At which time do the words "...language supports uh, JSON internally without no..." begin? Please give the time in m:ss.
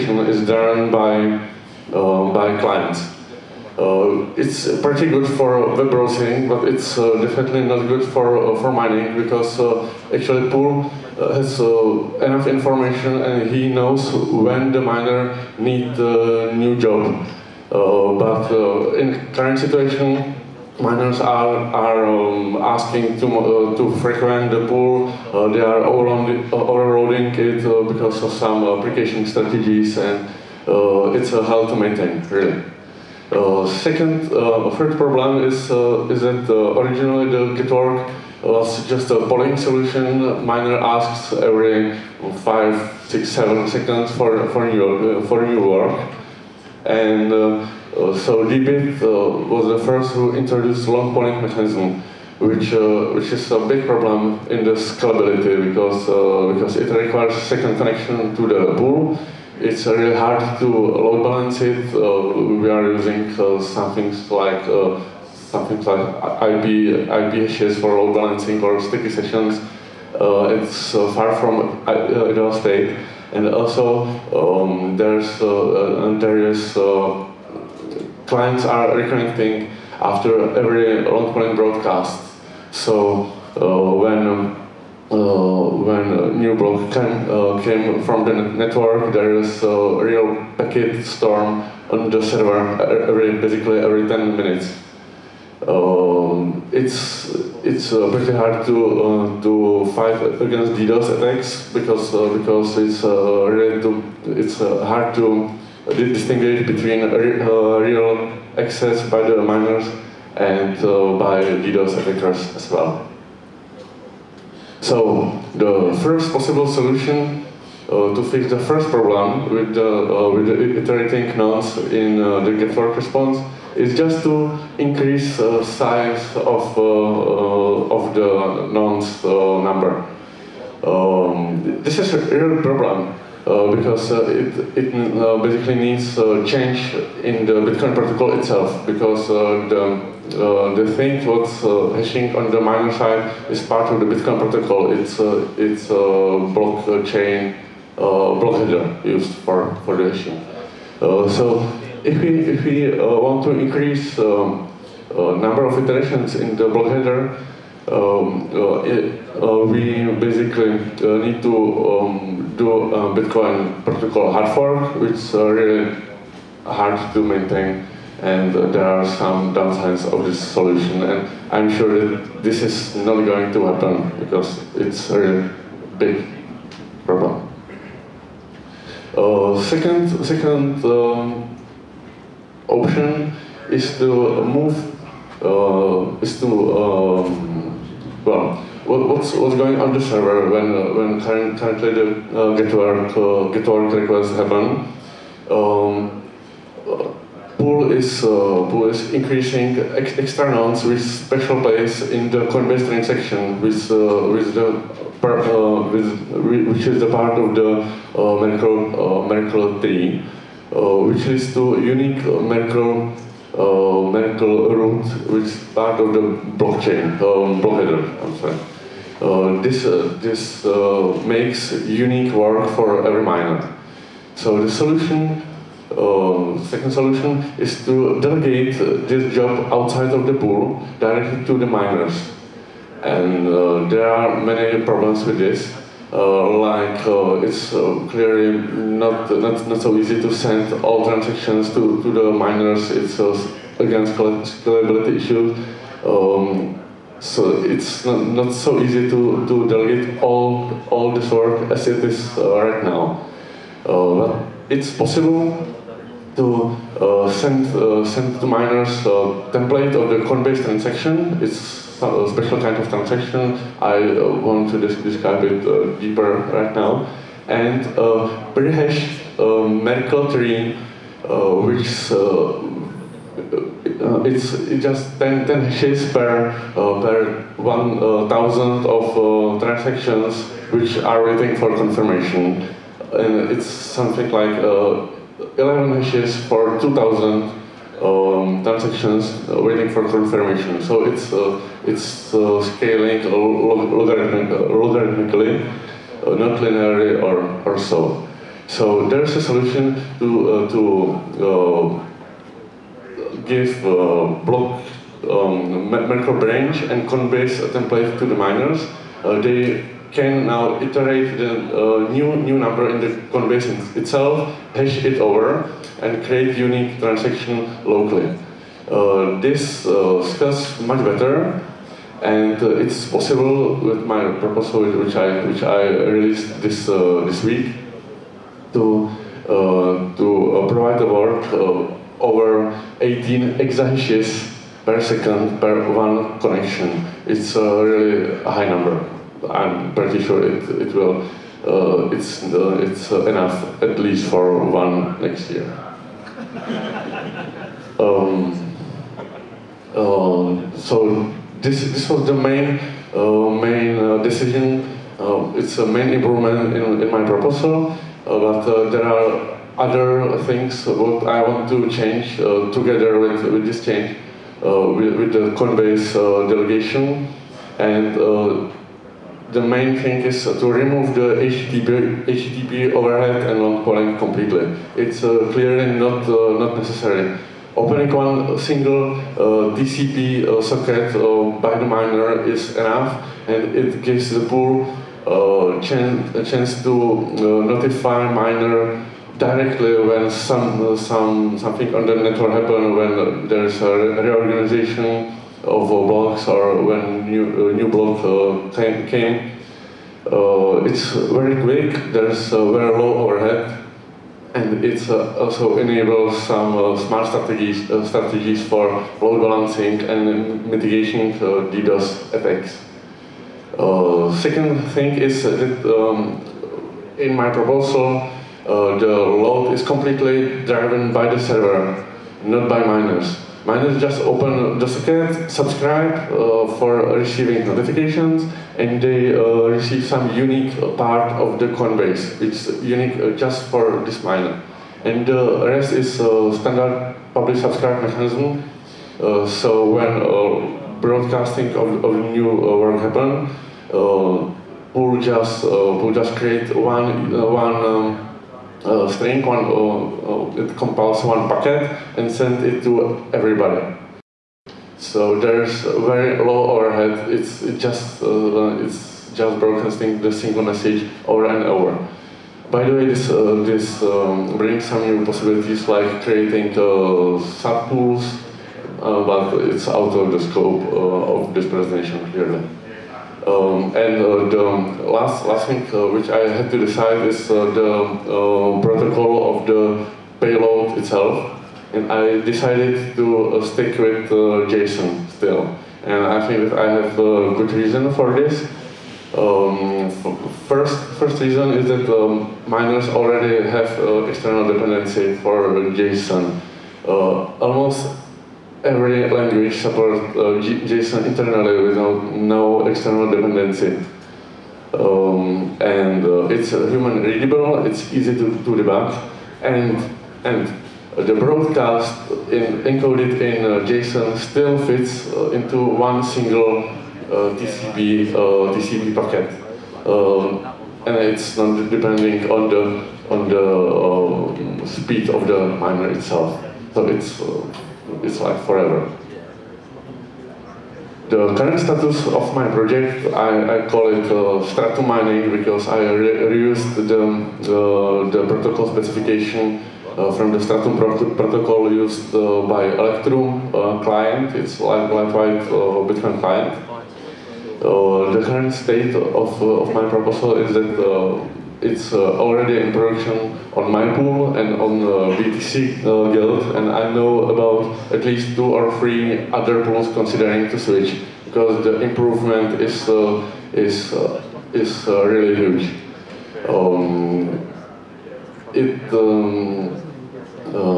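8:19.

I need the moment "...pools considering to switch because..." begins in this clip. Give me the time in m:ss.
9:19.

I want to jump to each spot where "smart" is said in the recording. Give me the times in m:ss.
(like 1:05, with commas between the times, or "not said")
6:46.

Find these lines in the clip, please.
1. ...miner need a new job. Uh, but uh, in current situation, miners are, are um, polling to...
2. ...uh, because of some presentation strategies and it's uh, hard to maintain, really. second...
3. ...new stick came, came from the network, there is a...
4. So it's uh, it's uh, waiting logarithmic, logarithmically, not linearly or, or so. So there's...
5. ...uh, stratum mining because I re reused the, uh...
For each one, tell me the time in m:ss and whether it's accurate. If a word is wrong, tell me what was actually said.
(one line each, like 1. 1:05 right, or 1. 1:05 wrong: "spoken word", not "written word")
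1. 0:14 wrong: "asking", not "polling"
2. 0:27 wrong: "application", not "presentation"
3. 1:26 wrong: "block", not "stick"
4. 4:50 wrong: "scaling", not "waiting"
5. 8:54 right.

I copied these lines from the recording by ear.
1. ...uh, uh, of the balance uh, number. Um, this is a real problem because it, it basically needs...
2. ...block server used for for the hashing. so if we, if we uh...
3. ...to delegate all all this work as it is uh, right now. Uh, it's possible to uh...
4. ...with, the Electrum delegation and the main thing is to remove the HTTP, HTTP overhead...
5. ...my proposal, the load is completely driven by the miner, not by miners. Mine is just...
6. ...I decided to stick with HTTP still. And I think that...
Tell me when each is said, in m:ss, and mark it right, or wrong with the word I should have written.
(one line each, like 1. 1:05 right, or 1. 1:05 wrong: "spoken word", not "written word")
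1. 2:06 wrong: "nonce", not "balance"
2. 2:27 wrong: "header", not "server"
3. 4:09 right
4. 6:05 wrong: "Coinbase", not "Electrum"
5. 6:57 wrong: "server", not "miner"
6. 8:02 wrong: "JSON", not "HTTP".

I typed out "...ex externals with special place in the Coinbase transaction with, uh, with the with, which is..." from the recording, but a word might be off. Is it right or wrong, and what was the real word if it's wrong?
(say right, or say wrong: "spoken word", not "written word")
right.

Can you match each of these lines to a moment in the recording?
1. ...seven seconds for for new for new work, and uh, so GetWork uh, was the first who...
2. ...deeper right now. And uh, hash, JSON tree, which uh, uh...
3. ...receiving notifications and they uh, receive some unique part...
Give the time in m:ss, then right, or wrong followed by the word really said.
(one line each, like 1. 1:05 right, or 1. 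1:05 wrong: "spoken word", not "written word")
1. 0:43 wrong: "Deepbit", not "GetWork"
2. 4:26 wrong: "Merkle", not "JSON"
3. 7:07 right.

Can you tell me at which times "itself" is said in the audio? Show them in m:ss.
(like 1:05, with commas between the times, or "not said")
2:18, 5:13, 8:00, 8:46.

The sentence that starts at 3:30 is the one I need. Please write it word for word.
Uh, which leads to unique Merkle uh, Merkle uh, root, which is part of the blockchain, um, block header, I'm sorry.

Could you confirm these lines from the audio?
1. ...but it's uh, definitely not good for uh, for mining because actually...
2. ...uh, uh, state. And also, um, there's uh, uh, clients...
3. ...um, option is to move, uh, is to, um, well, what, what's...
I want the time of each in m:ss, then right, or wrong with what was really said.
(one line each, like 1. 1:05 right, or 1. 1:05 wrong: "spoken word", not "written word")
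1. 0:06 right
2. 1:12 right
3. 3:00 right.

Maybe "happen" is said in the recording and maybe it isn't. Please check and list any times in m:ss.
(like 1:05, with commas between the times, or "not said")
2:53, 3:14, 6:32, 7:22.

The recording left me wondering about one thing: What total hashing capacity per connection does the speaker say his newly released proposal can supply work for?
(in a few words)
18 exahashes per second.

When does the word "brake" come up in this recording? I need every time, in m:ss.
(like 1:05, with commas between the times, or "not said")
not said.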